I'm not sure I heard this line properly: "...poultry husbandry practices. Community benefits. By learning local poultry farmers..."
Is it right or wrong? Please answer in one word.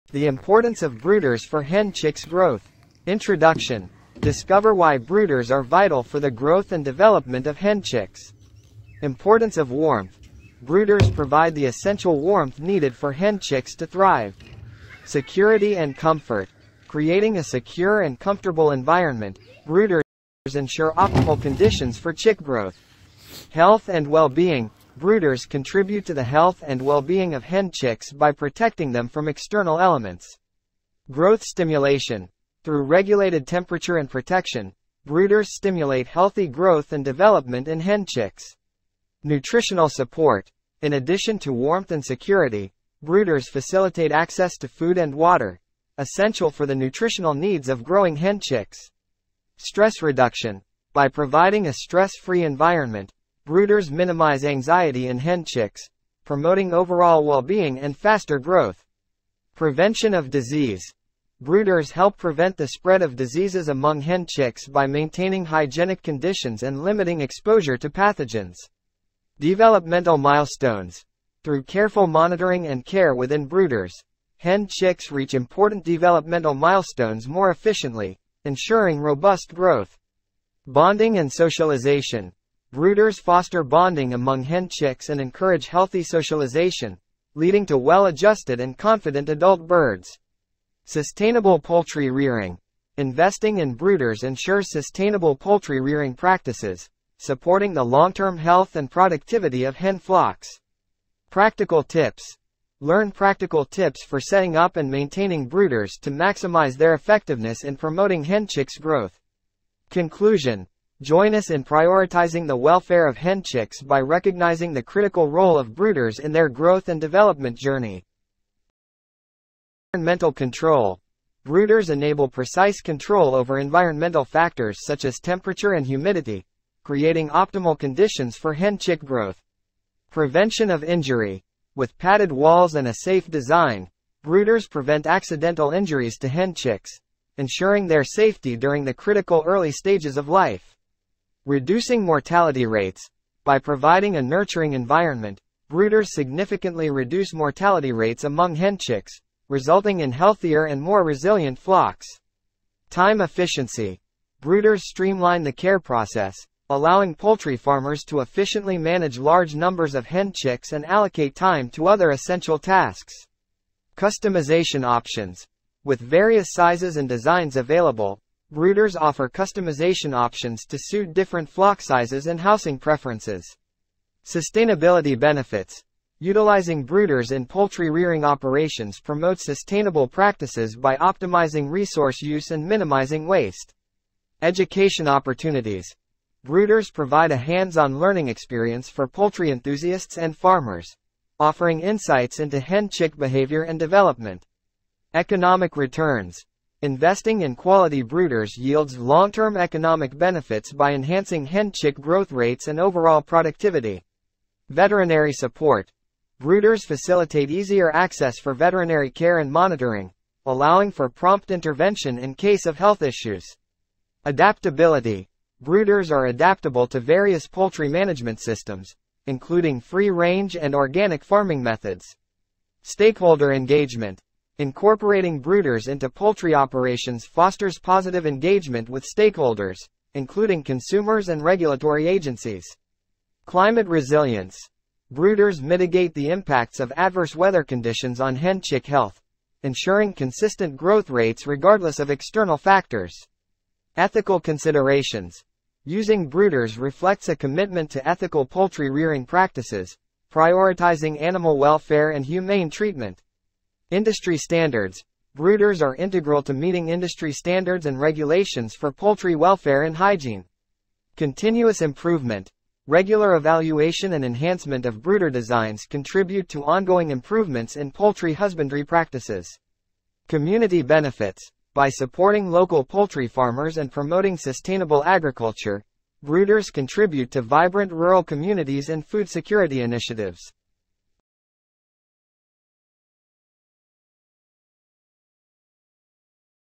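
wrong.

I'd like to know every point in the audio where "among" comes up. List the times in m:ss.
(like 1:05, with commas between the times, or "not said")
1:03, 1:24, 2:28.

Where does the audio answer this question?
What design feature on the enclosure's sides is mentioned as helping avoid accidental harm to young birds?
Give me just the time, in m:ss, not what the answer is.
2:11.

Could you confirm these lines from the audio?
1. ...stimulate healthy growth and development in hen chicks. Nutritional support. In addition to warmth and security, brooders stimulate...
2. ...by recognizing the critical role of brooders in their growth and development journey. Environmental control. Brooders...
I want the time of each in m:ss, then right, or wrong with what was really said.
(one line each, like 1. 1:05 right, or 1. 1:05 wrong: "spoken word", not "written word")
1. 0:35 wrong: "facilitate", not "stimulate"
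2. 1:53 right.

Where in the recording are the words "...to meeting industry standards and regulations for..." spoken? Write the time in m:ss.
4:16.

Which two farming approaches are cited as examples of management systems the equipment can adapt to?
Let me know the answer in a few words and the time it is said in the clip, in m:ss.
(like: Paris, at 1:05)
free-range and organic, at 3:39.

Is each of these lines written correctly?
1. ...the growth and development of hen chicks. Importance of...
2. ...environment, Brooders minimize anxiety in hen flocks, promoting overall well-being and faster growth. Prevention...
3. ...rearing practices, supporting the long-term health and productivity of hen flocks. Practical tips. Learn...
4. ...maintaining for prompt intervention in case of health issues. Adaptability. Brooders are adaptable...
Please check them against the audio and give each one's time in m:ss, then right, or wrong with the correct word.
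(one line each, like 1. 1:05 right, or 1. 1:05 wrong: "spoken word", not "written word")
1. 0:06 right
2. 0:52 wrong: "chicks", not "flocks"
3. 1:35 right
4. 3:30 wrong: "allowing", not "maintaining".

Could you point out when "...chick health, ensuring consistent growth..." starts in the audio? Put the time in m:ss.
3:58.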